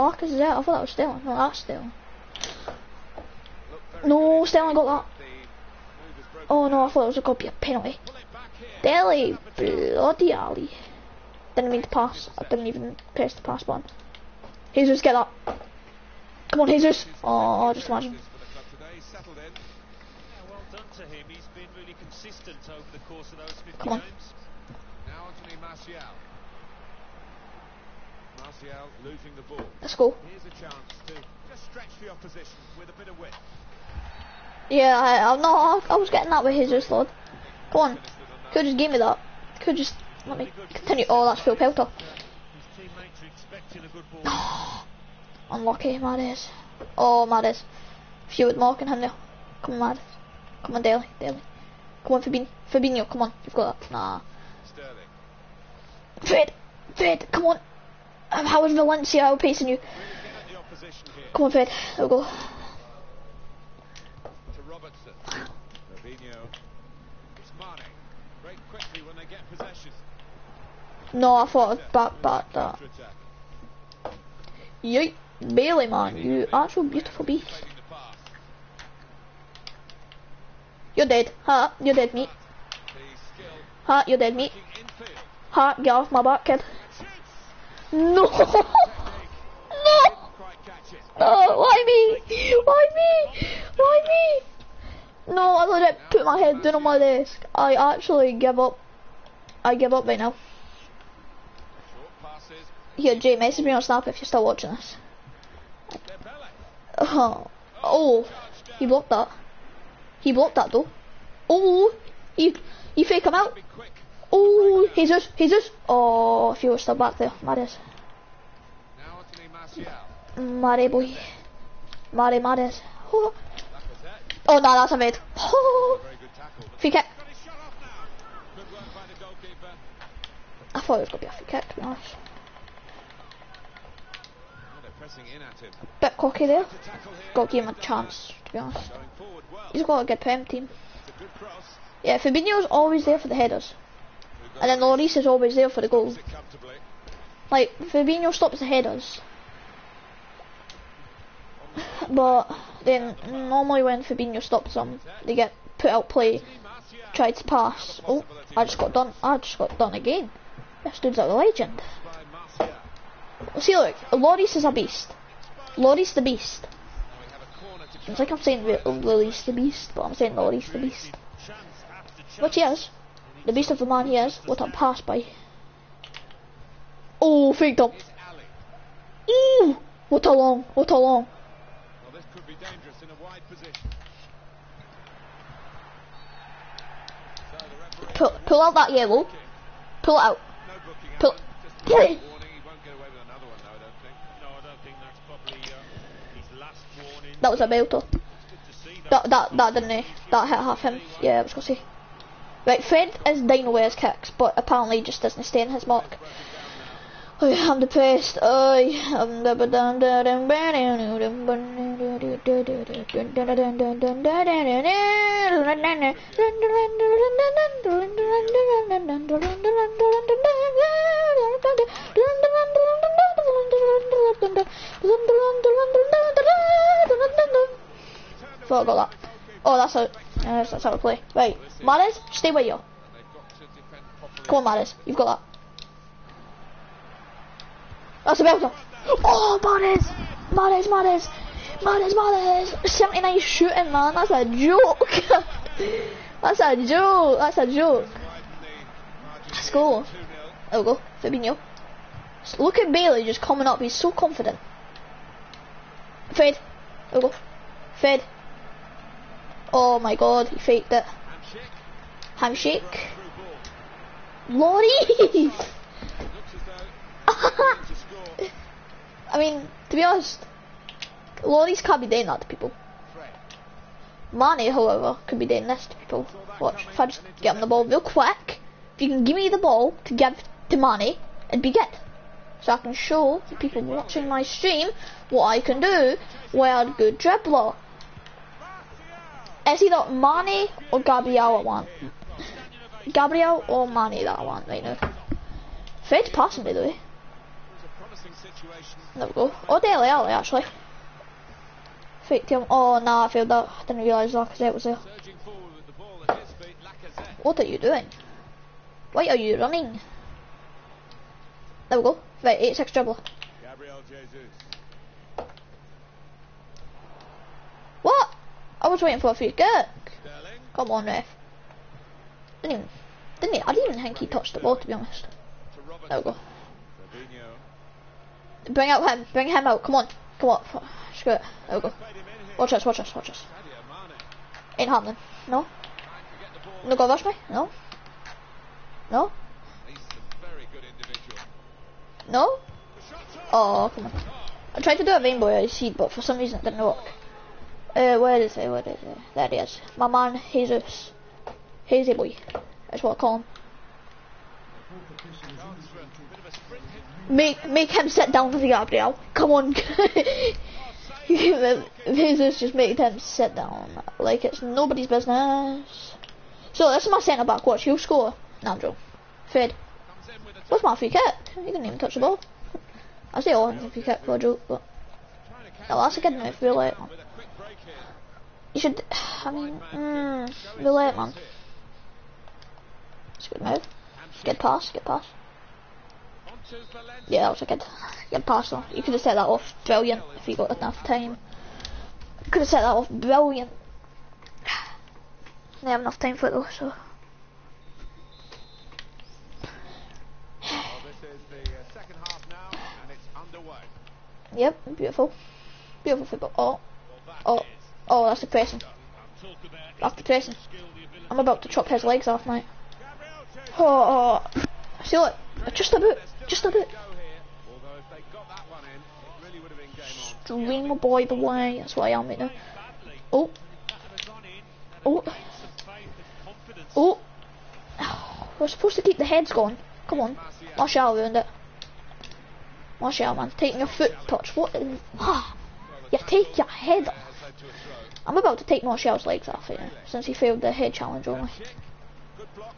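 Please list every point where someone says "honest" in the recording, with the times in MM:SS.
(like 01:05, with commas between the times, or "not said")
02:11, 02:18, 04:30, 05:24.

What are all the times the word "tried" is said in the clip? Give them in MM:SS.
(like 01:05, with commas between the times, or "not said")
02:37, 05:44.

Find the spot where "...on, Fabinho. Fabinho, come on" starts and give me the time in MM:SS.
00:52.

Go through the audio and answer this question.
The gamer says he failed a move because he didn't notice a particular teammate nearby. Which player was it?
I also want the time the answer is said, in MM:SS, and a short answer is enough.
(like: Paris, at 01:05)
Lacazette, at 05:04.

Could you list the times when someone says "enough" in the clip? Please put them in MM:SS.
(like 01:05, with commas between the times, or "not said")
06:30, 06:36.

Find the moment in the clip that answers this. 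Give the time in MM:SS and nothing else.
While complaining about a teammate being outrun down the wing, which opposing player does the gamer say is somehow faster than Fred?
00:58.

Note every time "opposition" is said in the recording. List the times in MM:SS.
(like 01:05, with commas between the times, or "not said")
00:32.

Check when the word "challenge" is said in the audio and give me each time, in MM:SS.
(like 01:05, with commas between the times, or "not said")
07:20.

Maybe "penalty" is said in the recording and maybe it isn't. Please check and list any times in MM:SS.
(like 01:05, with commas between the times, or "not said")
00:07.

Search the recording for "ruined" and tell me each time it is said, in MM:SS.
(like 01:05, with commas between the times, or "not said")
07:11.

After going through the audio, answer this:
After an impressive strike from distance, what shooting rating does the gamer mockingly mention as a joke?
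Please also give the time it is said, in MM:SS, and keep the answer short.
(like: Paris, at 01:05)
79, at 04:02.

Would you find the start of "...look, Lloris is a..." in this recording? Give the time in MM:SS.
02:43.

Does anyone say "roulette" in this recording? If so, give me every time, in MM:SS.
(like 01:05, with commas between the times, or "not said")
06:16, 06:20.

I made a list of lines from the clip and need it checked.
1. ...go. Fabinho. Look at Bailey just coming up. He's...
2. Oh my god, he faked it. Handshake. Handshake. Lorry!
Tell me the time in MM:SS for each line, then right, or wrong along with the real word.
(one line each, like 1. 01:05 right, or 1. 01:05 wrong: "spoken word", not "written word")
1. 04:10 right
2. 04:19 right.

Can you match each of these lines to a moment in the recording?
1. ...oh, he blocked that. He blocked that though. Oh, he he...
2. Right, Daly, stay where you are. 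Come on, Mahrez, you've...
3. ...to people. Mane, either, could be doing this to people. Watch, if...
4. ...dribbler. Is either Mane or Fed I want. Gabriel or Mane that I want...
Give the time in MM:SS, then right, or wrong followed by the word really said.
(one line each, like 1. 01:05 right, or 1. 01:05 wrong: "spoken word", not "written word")
1. 01:47 right
2. 03:51 wrong: "Mahrez", not "Daly"
3. 04:32 wrong: "however", not "either"
4. 04:47 wrong: "Gabriel", not "Fed".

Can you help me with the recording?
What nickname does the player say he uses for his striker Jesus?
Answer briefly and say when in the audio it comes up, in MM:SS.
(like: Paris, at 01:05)
Hazy boy, at 05:51.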